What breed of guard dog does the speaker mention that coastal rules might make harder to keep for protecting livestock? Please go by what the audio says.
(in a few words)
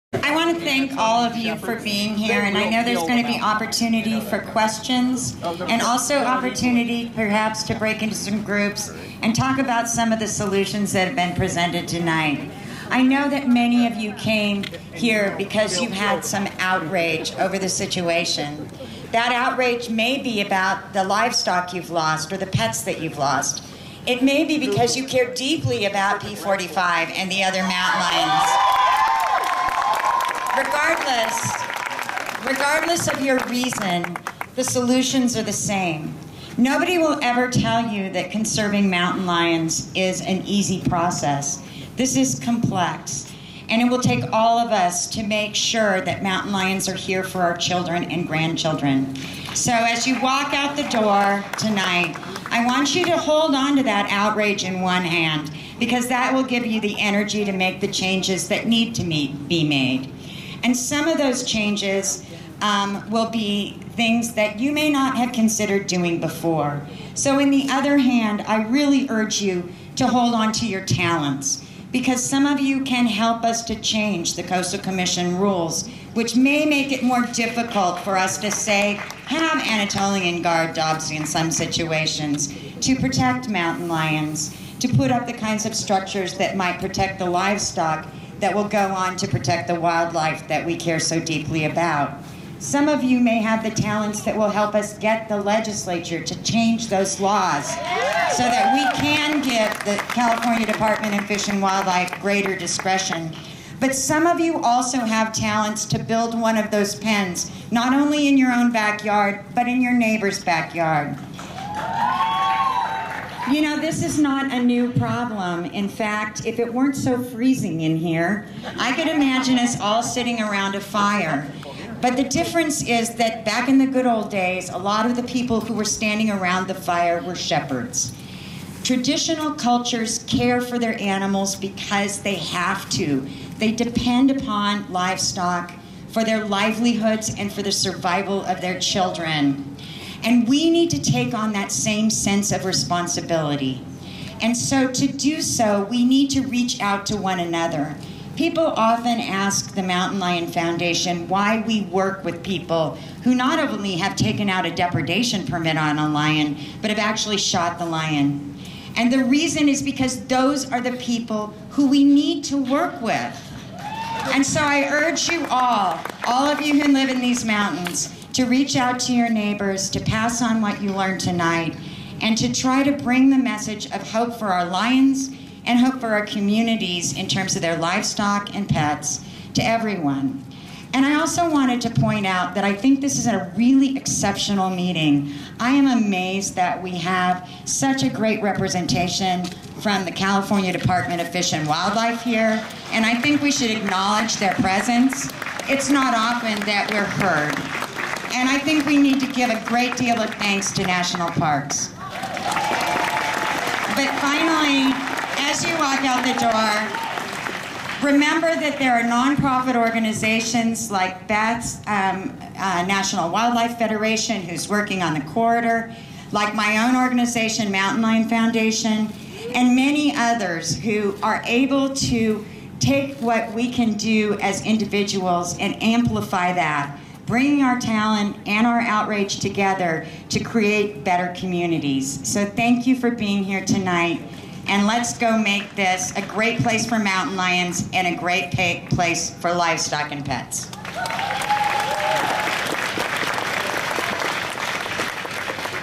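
Anatolian.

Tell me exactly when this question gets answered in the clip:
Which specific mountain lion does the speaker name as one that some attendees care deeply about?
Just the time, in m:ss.
0:26.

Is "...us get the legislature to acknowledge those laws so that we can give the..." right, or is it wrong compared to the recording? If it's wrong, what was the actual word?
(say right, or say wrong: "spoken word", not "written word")
wrong: "change", not "acknowledge".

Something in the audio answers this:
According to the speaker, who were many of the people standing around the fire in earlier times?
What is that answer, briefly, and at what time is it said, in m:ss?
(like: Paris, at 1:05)
Shepherds, at 2:07.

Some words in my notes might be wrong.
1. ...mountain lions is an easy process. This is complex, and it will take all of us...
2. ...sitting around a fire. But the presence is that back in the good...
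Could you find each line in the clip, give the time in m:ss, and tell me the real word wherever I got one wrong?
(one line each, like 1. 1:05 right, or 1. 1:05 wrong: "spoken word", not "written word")
1. 0:38 right
2. 2:00 wrong: "difference", not "presence".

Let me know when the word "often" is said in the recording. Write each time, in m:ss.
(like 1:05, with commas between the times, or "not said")
2:28, 3:16.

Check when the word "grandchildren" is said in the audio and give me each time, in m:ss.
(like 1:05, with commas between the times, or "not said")
0:48.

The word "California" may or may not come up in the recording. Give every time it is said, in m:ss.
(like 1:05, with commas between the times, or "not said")
1:40, 3:10.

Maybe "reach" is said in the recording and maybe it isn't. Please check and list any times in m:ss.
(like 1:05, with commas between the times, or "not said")
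2:26, 2:48.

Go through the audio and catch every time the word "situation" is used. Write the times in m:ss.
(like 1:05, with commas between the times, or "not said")
0:17, 1:21.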